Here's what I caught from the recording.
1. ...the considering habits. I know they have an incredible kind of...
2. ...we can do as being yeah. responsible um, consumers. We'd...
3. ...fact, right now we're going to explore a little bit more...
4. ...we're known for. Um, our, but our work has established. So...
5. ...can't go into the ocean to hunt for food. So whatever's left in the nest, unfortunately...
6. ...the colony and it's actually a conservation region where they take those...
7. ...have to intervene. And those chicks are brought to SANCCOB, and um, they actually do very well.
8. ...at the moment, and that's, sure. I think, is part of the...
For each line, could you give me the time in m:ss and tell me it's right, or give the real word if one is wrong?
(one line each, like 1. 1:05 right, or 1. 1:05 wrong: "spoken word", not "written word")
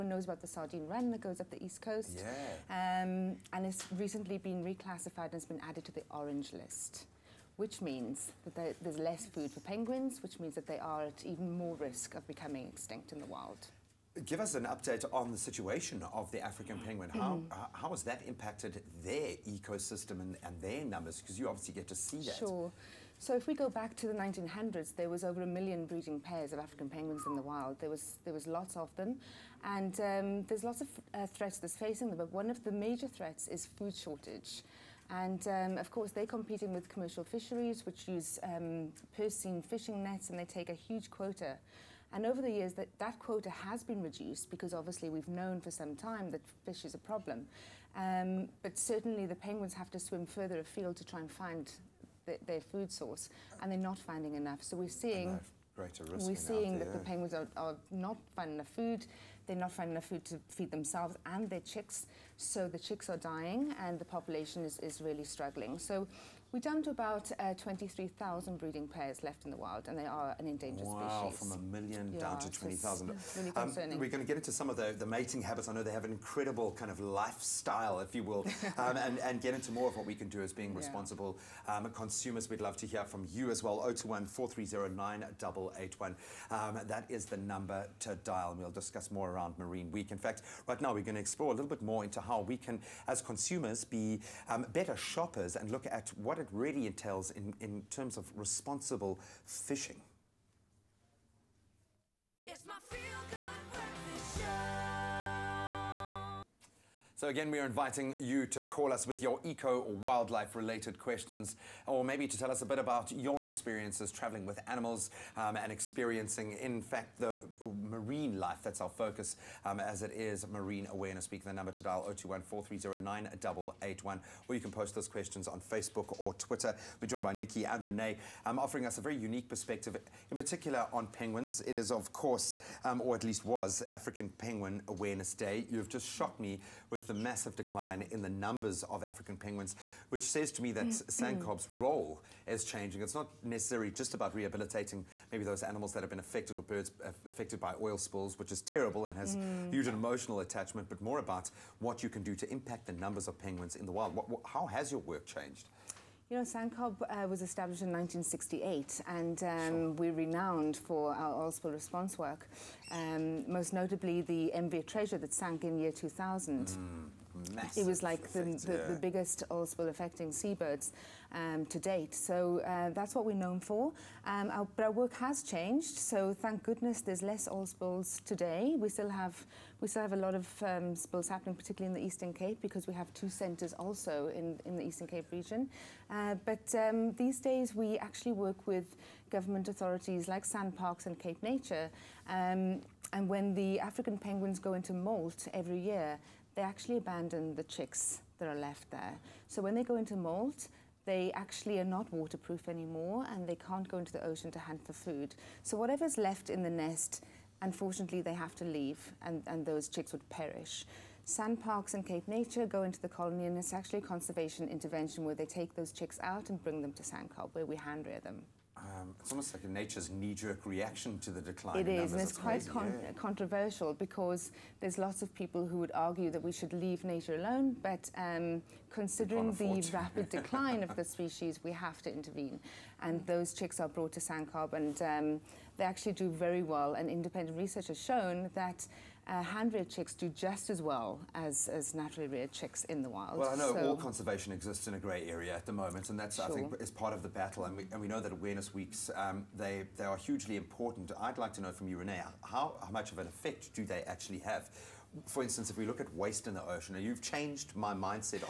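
1. 1:14 wrong: "mating", not "considering"
2. 1:20 right
3. 1:30 right
4. 2:53 wrong: "changed", not "established"
5. 3:23 right
6. 3:32 wrong: "intervention", not "region"
7. 3:51 right
8. 4:05 right.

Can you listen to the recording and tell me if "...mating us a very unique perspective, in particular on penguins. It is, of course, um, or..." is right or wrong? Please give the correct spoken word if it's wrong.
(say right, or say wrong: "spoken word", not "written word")
wrong: "offering", not "mating".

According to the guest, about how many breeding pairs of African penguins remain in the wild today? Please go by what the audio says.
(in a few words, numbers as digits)
23,000.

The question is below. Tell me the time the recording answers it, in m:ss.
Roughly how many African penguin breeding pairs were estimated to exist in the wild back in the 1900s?
0:25.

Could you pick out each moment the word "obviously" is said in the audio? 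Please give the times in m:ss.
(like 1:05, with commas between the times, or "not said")
0:21, 0:44.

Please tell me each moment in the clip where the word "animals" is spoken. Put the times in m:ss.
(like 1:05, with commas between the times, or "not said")
1:54, 2:25.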